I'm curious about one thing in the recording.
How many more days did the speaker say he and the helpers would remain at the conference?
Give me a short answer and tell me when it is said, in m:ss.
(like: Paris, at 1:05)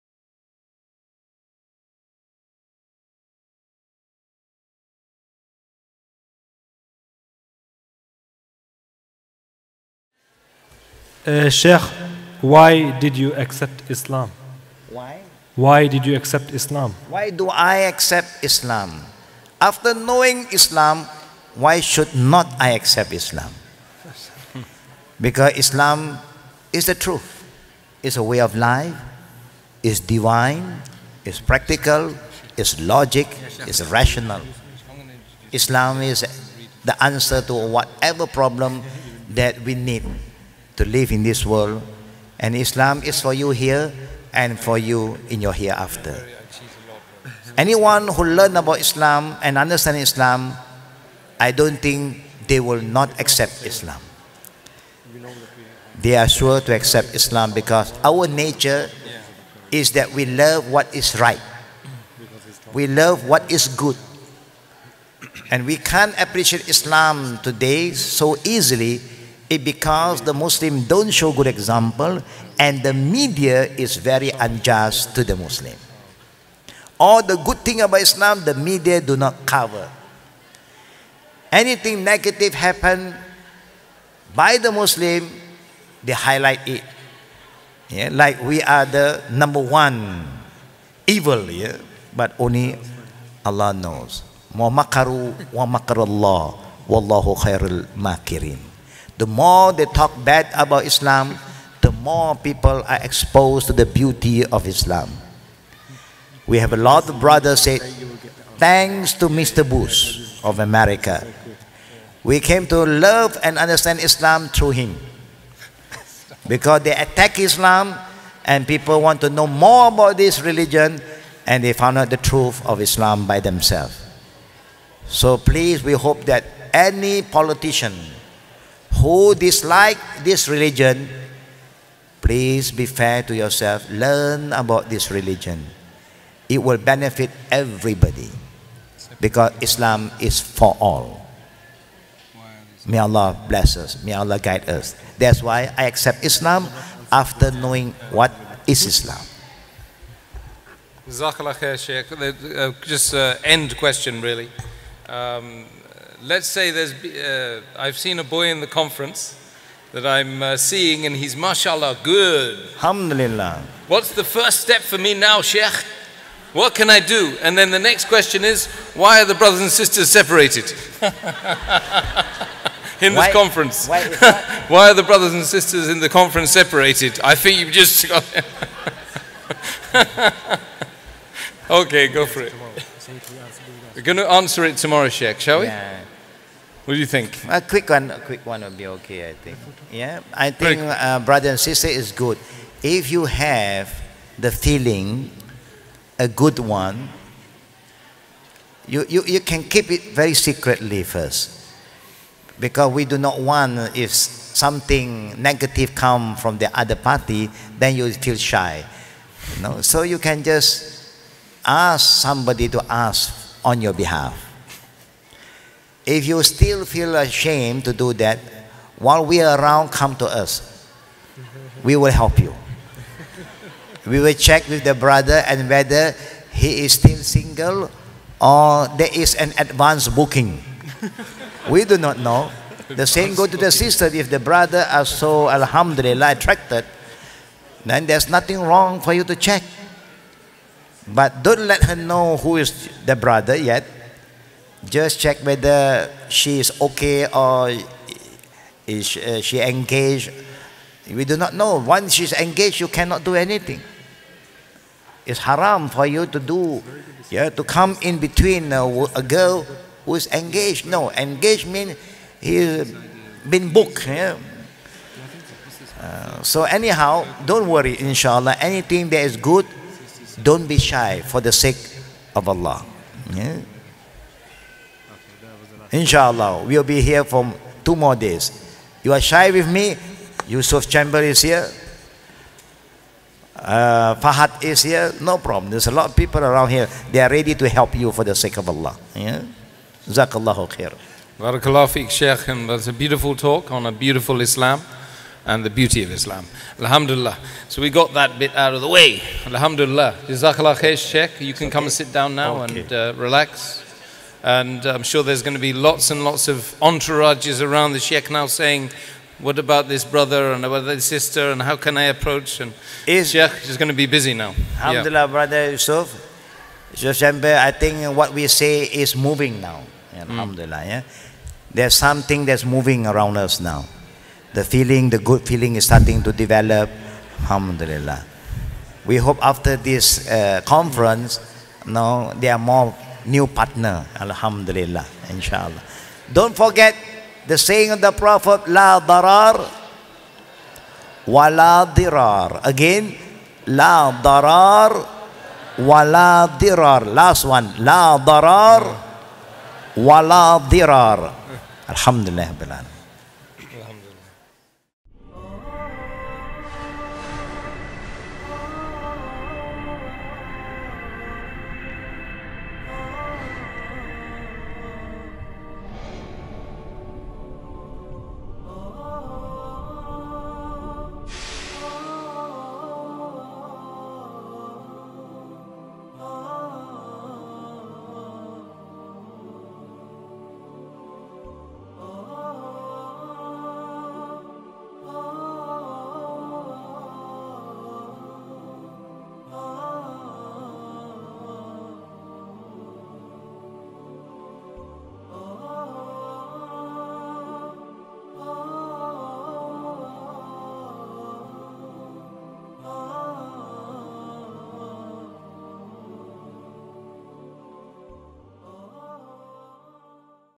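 2, at 4:37.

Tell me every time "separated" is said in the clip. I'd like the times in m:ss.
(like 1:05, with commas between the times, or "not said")
2:50, 2:56.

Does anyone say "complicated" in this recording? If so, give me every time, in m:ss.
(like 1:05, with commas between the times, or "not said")
not said.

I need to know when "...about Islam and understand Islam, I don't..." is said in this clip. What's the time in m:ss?
0:48.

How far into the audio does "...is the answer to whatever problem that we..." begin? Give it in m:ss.
0:36.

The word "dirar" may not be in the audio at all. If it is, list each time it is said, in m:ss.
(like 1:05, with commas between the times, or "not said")
5:41, 5:46, 5:50.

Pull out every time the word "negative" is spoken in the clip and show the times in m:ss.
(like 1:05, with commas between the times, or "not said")
1:21, 3:25.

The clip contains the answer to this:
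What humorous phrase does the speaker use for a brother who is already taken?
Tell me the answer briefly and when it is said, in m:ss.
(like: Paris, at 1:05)
advance booking, at 3:49.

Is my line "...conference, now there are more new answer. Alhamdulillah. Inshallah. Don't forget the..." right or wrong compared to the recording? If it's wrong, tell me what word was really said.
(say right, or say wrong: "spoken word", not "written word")
wrong: "partner", not "answer".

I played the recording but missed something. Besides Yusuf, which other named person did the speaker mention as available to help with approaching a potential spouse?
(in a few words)
Fahad.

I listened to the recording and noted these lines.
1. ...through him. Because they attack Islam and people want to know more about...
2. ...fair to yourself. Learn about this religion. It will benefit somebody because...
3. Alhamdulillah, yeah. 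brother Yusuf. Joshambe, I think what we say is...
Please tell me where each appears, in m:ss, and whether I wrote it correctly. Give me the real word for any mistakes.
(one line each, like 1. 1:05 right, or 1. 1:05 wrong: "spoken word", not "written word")
1. 1:54 right
2. 2:12 wrong: "everybody", not "somebody"
3. 5:14 right.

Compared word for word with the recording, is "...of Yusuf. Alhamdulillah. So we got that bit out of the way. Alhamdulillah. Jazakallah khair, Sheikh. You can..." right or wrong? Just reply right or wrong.
wrong.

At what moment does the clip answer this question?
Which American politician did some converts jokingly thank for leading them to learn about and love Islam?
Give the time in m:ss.
1:49.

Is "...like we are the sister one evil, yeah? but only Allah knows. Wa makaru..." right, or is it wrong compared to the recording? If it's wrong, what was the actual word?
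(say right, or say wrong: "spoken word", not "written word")
wrong: "number", not "sister".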